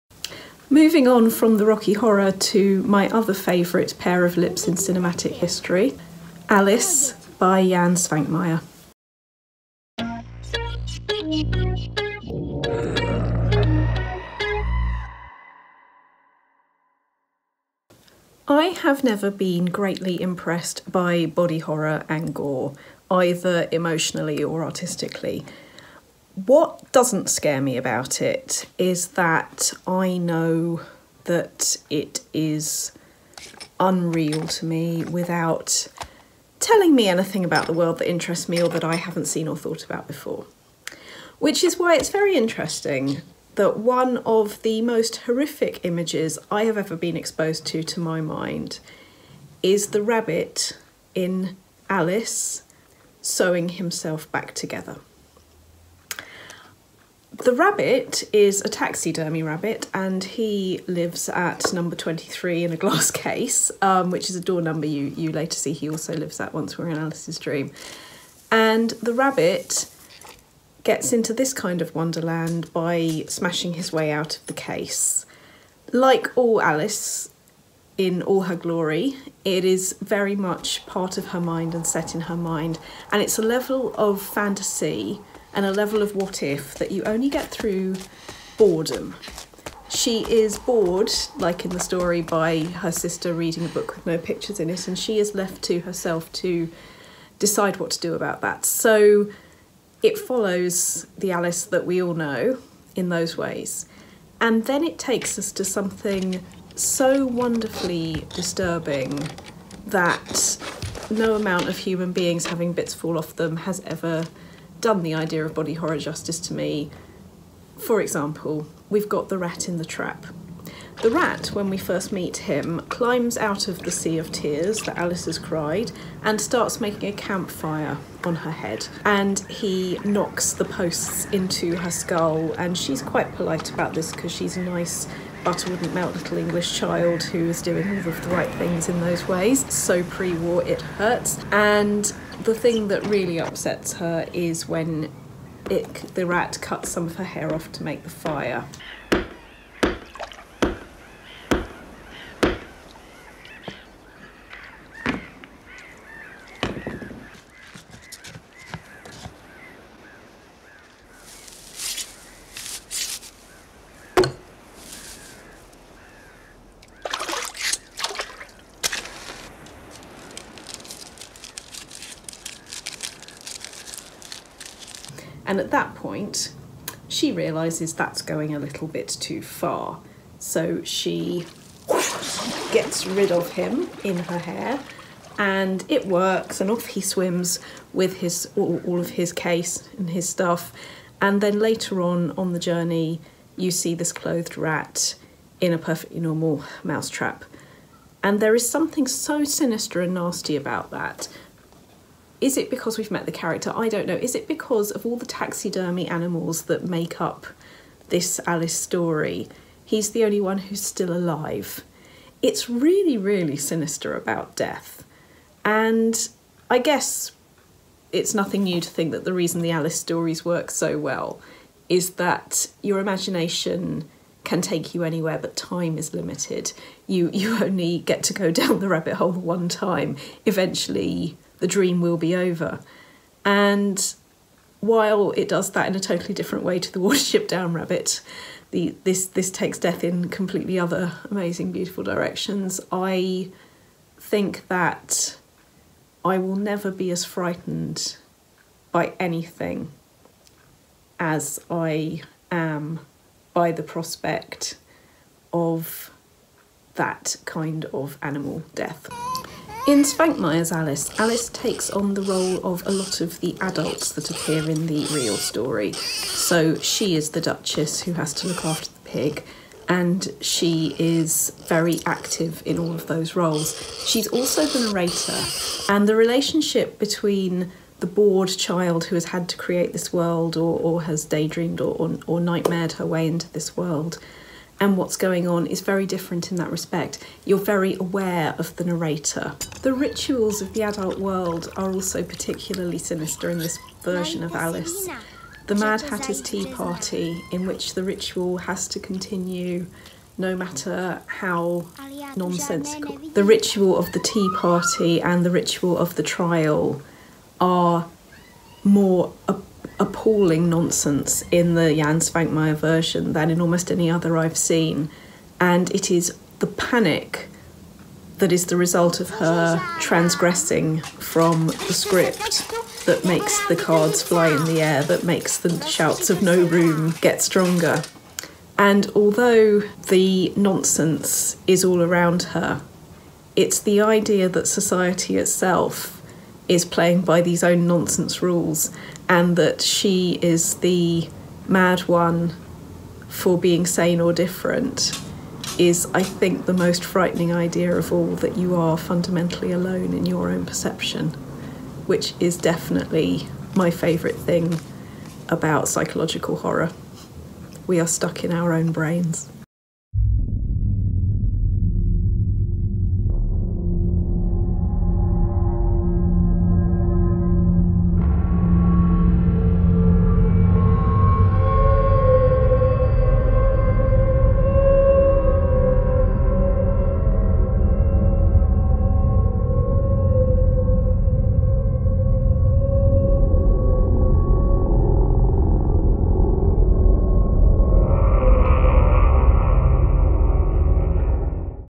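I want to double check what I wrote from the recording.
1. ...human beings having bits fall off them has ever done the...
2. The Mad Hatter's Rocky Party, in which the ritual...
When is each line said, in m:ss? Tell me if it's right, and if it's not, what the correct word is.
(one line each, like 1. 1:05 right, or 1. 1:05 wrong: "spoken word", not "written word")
1. 1:51 right
2. 4:55 wrong: "Tea", not "Rocky".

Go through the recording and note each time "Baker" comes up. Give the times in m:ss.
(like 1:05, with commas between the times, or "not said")
not said.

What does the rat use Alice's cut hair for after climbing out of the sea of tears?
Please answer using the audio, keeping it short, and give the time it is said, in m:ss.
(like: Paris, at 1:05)
To make the fire, at 2:27.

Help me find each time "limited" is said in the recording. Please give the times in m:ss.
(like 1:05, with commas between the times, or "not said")
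3:46.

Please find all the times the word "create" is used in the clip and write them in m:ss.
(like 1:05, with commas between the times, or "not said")
4:39.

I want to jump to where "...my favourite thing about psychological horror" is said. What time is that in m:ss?
5:53.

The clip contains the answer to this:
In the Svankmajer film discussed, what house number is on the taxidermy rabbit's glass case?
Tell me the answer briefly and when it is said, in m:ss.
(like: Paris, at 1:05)
23, at 1:01.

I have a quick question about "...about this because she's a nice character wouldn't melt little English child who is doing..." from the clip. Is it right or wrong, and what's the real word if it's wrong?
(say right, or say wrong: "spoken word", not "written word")
wrong: "butter", not "character".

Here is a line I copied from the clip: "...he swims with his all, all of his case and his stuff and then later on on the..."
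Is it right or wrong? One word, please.
right.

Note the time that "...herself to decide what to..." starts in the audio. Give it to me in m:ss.
1:35.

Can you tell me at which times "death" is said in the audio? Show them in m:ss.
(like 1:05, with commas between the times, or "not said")
3:34, 3:59, 4:18.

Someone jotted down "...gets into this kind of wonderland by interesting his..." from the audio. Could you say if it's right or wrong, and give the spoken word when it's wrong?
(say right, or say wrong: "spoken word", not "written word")
wrong: "smashing", not "interesting".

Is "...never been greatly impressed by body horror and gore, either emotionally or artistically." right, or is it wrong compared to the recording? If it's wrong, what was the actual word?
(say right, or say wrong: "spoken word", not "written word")
right.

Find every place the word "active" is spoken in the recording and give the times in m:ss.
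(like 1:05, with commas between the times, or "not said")
4:32.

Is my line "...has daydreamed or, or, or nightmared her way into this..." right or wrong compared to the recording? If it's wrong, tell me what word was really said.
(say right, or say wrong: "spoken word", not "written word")
right.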